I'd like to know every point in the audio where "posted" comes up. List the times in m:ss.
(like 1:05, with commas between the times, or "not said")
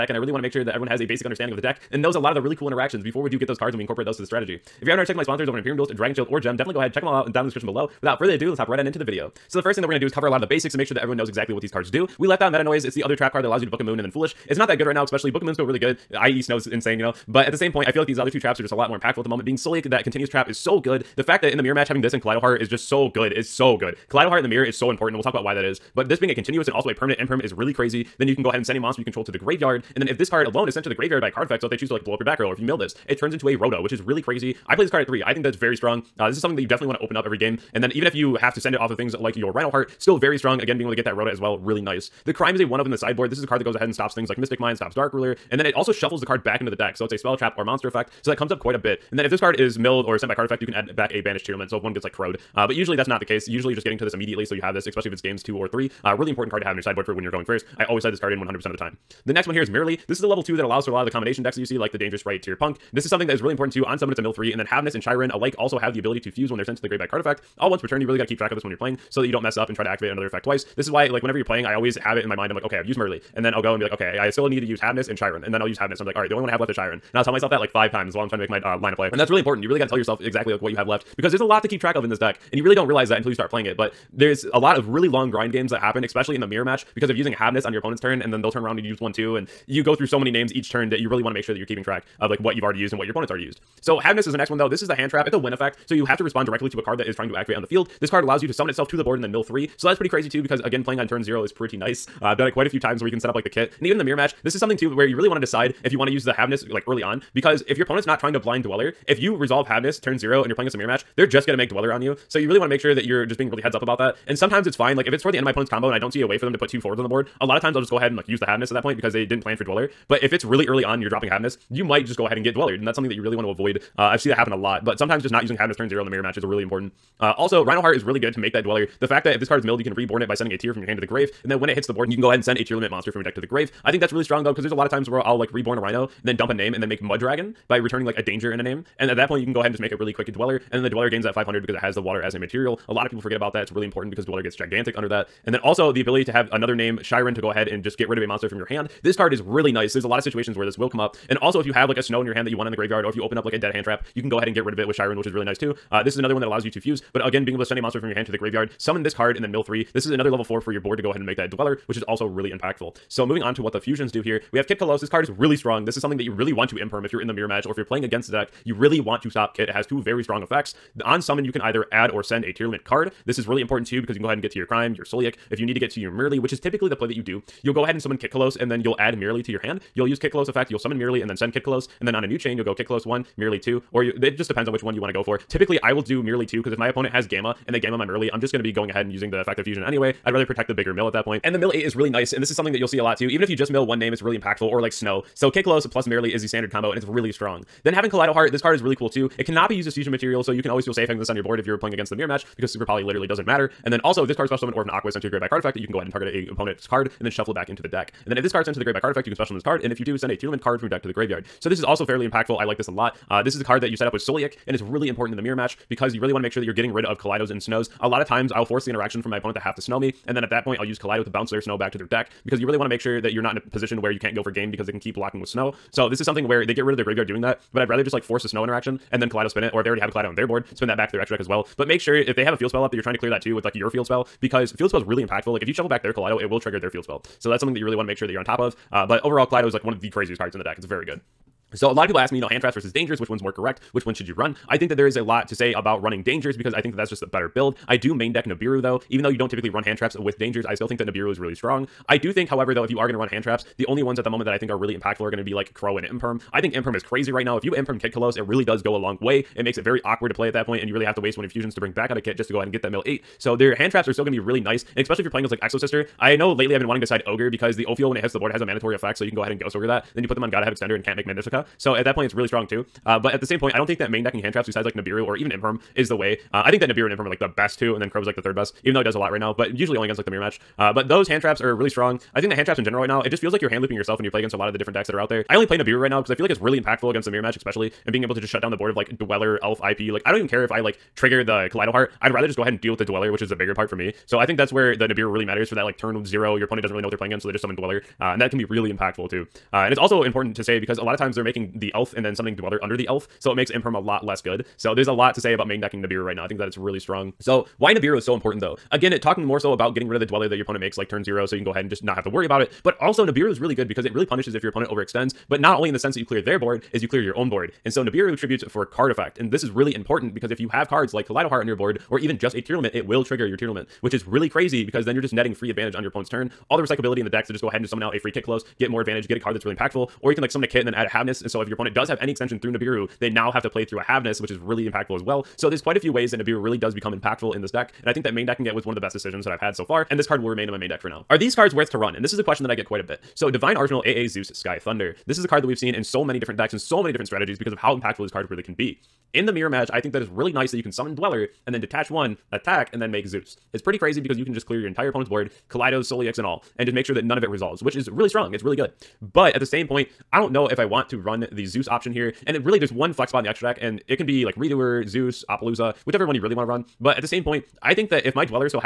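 not said.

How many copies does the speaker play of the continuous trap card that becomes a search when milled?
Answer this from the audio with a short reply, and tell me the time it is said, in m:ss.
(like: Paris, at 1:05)
3, at 0:34.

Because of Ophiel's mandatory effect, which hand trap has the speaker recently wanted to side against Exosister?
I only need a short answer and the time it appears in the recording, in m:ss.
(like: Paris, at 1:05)
Ghost Ogre, at 4:27.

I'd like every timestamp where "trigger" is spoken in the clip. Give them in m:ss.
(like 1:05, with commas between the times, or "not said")
3:56, 4:51, 5:23.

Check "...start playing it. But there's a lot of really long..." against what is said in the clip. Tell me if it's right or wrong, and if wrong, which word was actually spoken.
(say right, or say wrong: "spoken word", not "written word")
right.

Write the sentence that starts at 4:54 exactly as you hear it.
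So I think that's where the Nibiru really matters for that like turn zero.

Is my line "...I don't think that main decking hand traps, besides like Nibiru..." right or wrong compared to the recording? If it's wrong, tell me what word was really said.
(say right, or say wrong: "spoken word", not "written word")
right.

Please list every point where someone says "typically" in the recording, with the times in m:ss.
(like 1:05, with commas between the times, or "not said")
2:56, 3:05, 4:09.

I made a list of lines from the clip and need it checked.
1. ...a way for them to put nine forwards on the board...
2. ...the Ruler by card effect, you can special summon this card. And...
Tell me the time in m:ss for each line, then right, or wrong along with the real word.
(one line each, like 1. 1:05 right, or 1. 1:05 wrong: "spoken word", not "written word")
1. 1:56 wrong: "two", not "nine"
2. 3:28 wrong: "Grave", not "Ruler".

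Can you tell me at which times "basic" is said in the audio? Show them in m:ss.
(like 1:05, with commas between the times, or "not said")
0:01, 0:10.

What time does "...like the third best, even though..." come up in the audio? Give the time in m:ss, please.
4:38.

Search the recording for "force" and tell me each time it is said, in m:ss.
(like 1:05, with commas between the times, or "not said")
3:38, 3:48.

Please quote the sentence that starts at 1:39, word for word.
So that's pretty crazy too because again playing on turn zero is pretty nice.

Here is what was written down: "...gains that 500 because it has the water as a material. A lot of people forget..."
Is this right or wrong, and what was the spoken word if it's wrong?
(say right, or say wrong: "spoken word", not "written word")
right.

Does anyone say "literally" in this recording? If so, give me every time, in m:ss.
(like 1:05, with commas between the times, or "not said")
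3:23.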